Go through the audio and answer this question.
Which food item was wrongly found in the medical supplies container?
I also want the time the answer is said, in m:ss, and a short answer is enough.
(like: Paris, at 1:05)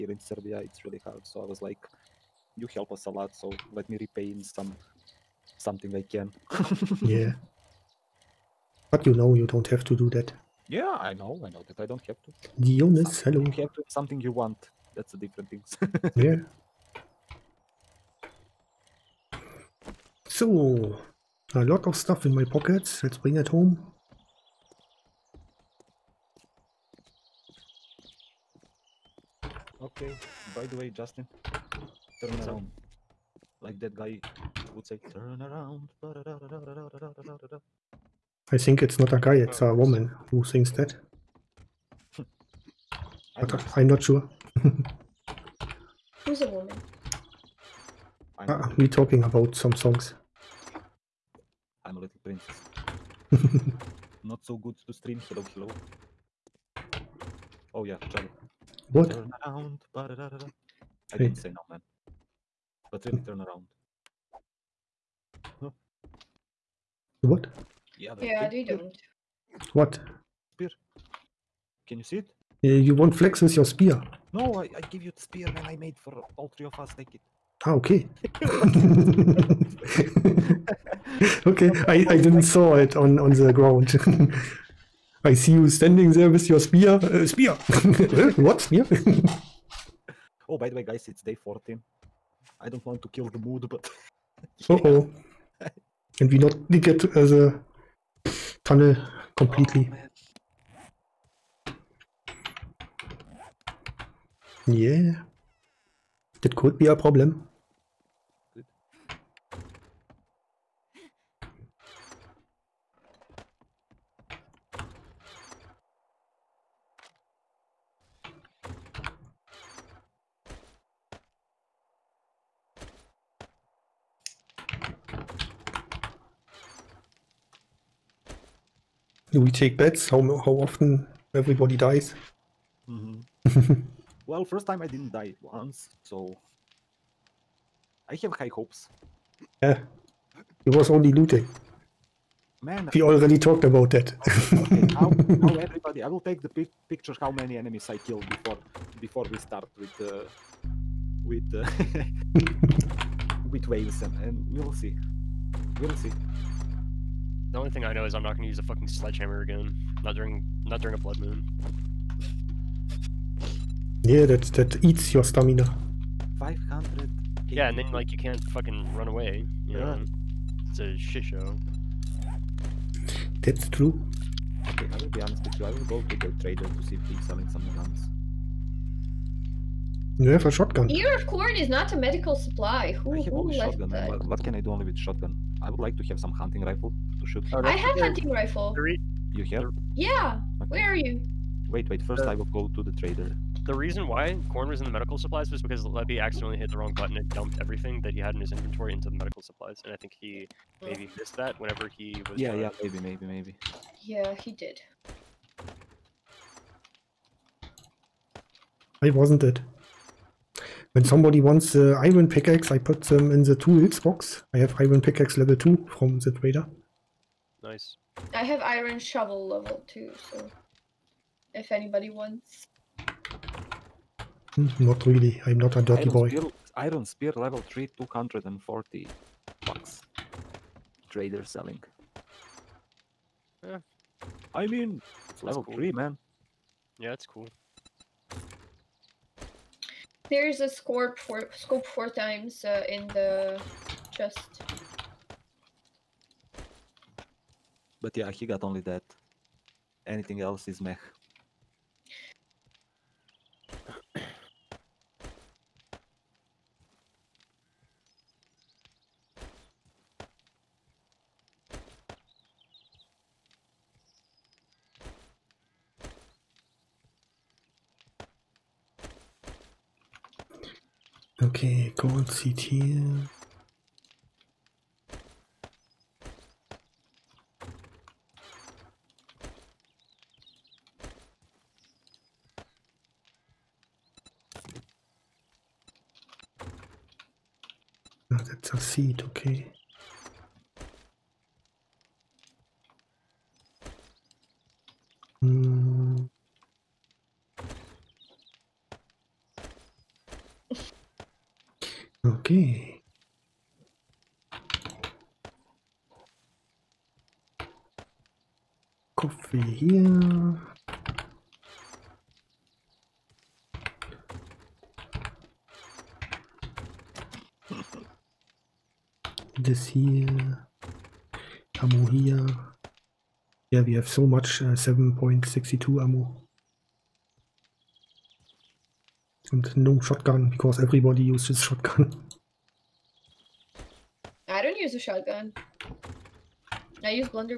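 Ear of corn, at 3:00.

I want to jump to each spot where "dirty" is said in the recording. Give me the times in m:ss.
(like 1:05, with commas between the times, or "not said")
3:45.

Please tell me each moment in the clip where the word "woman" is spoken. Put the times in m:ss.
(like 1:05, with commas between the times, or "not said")
0:39, 0:46.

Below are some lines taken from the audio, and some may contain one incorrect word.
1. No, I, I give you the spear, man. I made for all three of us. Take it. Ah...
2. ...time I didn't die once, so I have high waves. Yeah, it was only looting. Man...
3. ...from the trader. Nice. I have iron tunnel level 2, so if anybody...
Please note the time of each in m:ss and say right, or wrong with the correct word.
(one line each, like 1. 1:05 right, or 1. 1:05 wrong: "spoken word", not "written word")
1. 1:14 right
2. 2:14 wrong: "hopes", not "waves"
3. 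3:35 wrong: "shovel", not "tunnel".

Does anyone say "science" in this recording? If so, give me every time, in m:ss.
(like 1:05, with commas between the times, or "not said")
not said.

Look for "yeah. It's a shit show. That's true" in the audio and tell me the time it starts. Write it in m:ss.
2:49.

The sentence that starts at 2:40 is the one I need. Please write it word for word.
Not during not during a blood moon.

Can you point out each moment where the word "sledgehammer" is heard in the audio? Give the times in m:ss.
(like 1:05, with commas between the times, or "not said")
2:38.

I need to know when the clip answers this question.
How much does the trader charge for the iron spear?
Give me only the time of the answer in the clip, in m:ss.
3:47.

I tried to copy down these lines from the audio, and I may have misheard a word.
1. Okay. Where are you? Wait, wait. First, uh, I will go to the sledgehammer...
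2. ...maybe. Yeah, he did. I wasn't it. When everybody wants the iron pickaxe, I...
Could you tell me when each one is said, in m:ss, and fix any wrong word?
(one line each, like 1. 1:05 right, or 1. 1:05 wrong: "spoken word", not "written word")
1. 3:10 wrong: "trader", not "sledgehammer"
2. 3:23 wrong: "somebody", not "everybody".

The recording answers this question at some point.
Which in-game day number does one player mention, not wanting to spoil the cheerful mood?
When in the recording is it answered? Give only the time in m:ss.
1:31.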